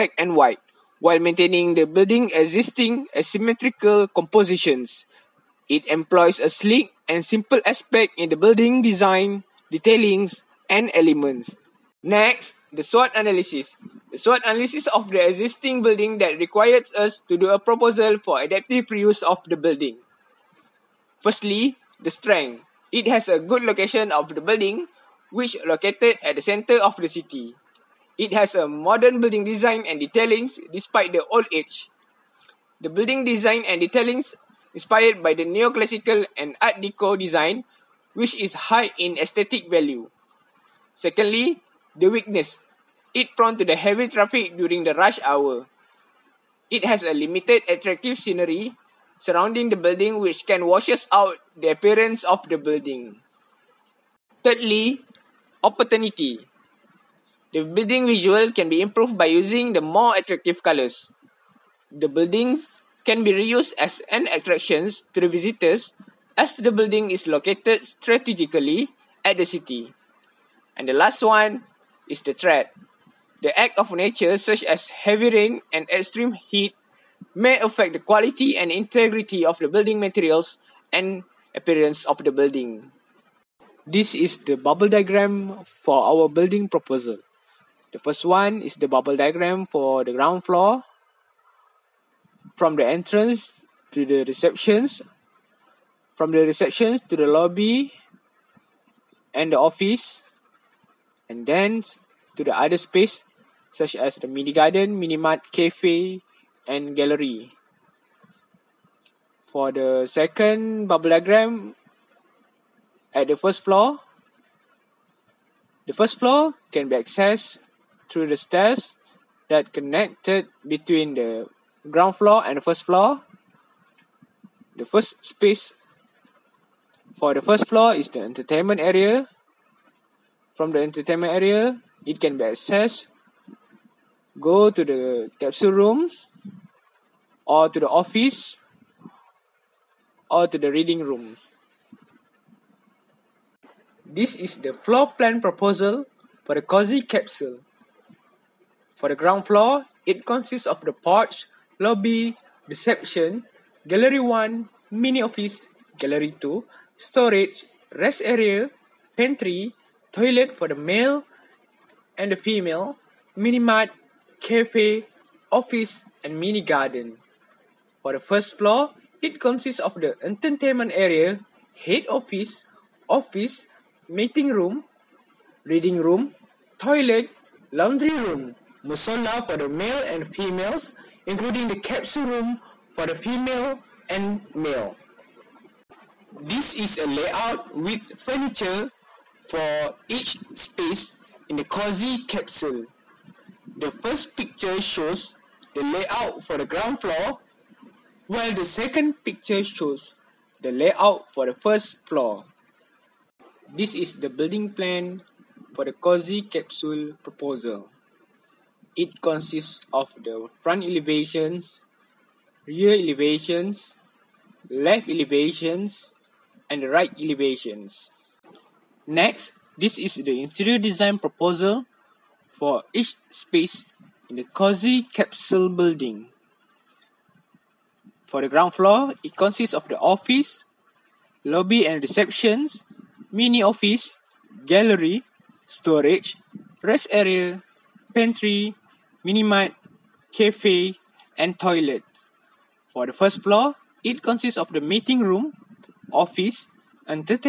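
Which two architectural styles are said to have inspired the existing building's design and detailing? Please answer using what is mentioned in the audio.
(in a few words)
Neoclassical and art deco.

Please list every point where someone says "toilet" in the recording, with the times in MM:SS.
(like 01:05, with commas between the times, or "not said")
02:40, 02:56, 04:01.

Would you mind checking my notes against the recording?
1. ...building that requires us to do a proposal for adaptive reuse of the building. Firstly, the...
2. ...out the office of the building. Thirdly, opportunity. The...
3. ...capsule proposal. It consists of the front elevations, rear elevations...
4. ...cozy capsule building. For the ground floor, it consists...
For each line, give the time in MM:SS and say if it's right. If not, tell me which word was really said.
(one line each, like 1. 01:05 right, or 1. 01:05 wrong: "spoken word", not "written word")
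1. 00:15 right
2. 00:51 wrong: "appearance", not "office"
3. 03:26 right
4. 03:44 right.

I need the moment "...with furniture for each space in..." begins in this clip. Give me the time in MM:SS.
03:07.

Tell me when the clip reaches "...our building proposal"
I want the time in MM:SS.
01:26.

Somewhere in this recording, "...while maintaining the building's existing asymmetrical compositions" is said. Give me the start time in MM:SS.
00:00.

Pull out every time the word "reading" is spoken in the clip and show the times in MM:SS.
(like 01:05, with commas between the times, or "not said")
02:20, 02:55.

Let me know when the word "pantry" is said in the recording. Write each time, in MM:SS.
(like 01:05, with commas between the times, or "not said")
02:39, 03:58.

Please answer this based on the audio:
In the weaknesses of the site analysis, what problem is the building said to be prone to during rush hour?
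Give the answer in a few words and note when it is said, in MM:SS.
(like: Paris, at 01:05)
Heavy traffic, at 00:43.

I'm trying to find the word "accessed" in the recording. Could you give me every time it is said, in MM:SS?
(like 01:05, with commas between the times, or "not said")
01:56, 02:12.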